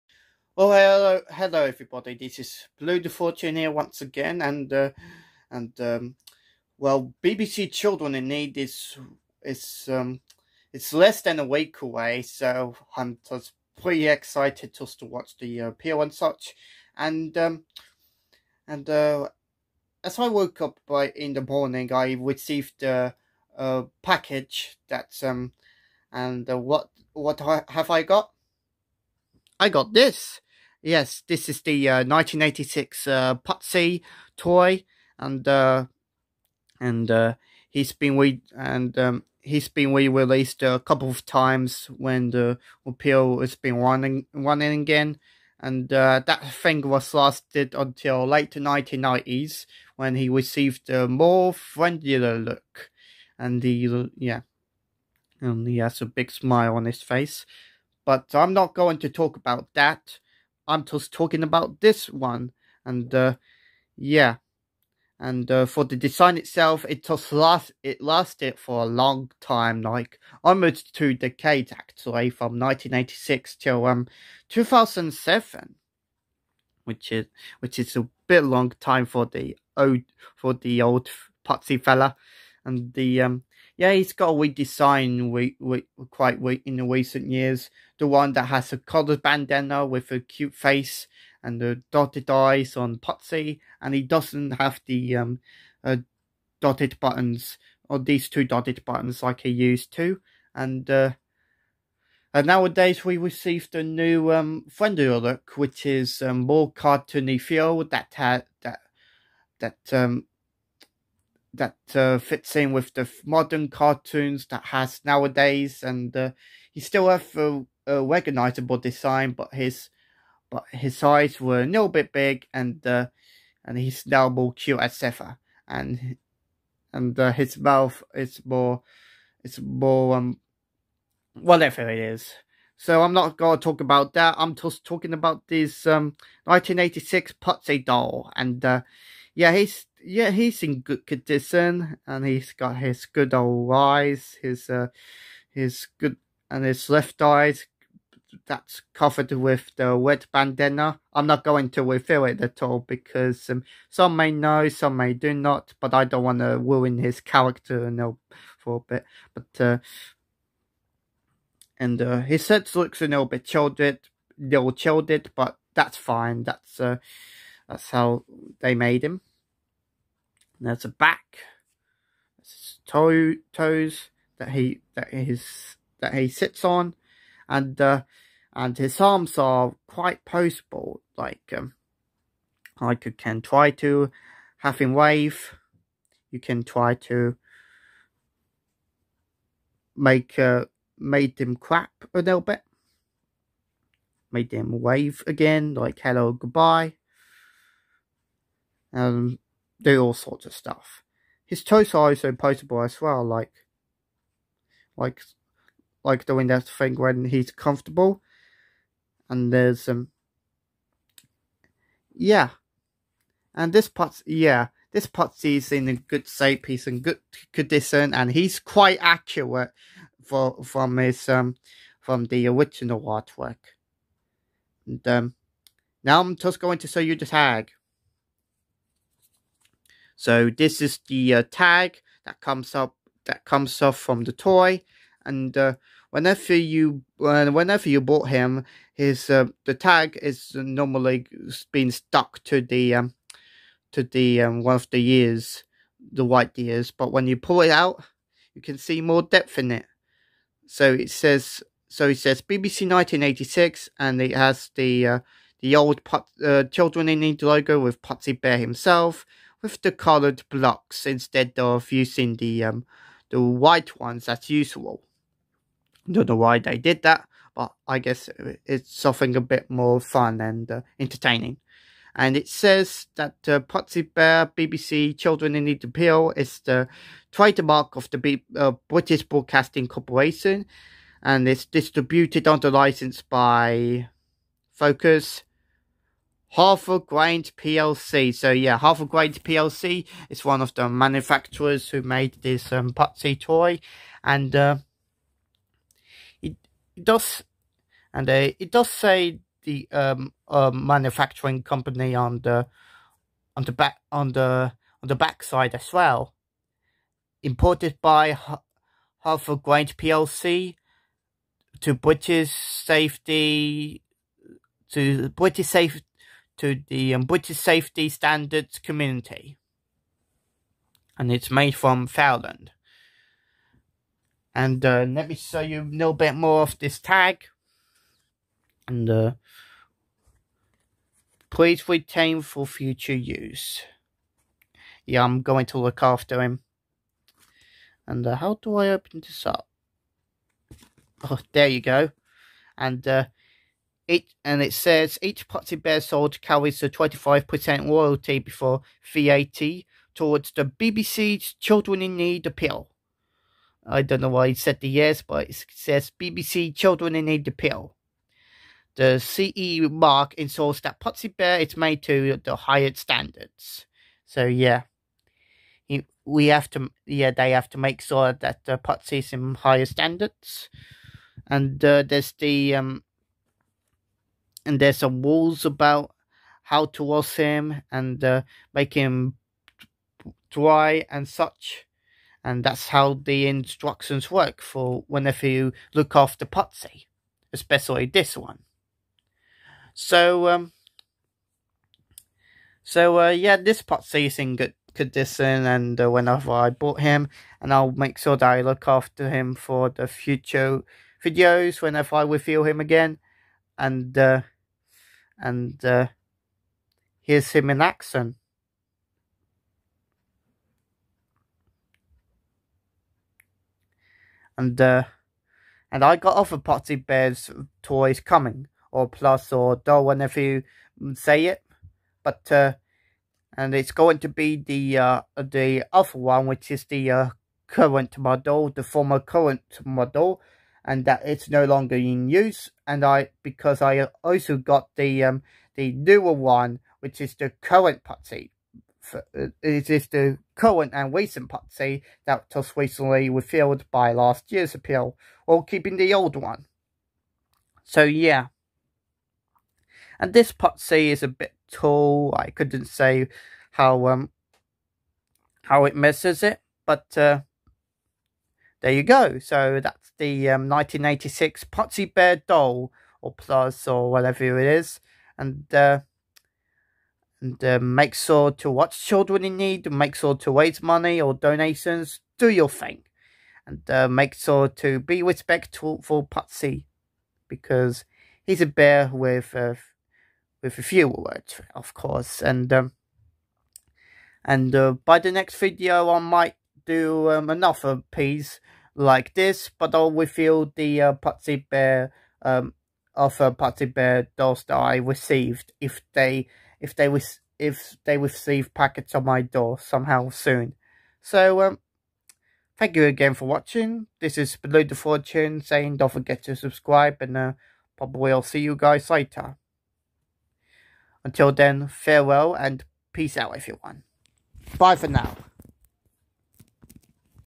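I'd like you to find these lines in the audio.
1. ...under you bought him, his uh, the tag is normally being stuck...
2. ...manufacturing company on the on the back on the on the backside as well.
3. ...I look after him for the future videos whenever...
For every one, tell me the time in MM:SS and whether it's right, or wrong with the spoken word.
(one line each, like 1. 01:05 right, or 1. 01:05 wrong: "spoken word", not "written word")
1. 03:57 wrong: "whenever", not "under"
2. 05:00 right
3. 06:38 right.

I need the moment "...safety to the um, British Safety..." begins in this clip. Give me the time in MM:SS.
05:15.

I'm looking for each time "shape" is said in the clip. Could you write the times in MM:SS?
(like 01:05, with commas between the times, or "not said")
03:36.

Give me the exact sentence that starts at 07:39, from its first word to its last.
So that's the um, 1986 Pudsey Bear doll or plus or whatever it is.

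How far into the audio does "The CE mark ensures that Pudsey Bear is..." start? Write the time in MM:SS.
05:58.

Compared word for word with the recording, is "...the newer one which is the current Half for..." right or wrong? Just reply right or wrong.
wrong.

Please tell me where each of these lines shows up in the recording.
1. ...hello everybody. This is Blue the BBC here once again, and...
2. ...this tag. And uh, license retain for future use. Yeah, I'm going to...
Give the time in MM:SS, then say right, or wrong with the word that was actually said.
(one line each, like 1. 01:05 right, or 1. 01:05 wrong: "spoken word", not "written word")
1. 00:01 wrong: "Fortune", not "BBC"
2. 05:26 wrong: "please", not "license".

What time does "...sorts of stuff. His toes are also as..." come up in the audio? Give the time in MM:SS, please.
03:20.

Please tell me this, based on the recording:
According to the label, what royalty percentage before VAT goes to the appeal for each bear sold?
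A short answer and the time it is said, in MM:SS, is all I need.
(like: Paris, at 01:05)
25%, at 05:46.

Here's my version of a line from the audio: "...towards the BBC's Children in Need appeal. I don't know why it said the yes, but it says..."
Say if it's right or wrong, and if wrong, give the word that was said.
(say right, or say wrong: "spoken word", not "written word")
right.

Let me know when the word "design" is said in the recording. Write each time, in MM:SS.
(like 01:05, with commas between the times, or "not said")
01:05, 01:24, 01:58.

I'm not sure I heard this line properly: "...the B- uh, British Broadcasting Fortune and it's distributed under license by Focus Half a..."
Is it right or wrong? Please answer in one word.
wrong.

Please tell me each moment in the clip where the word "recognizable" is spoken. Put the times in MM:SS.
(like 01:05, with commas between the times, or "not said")
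01:58.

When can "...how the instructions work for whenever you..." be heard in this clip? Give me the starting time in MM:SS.
06:22.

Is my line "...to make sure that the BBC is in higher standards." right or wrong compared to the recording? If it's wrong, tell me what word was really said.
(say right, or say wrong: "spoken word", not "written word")
wrong: "Pudsey", not "BBC".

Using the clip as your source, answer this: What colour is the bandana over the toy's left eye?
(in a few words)
Red.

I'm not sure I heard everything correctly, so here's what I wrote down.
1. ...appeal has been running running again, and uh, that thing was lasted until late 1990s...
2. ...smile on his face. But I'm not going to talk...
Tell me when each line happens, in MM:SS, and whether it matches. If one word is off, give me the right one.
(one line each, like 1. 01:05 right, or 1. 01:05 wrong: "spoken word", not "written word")
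1. 00:42 right
2. 00:56 right.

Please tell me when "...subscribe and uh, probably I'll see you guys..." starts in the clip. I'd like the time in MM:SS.
08:26.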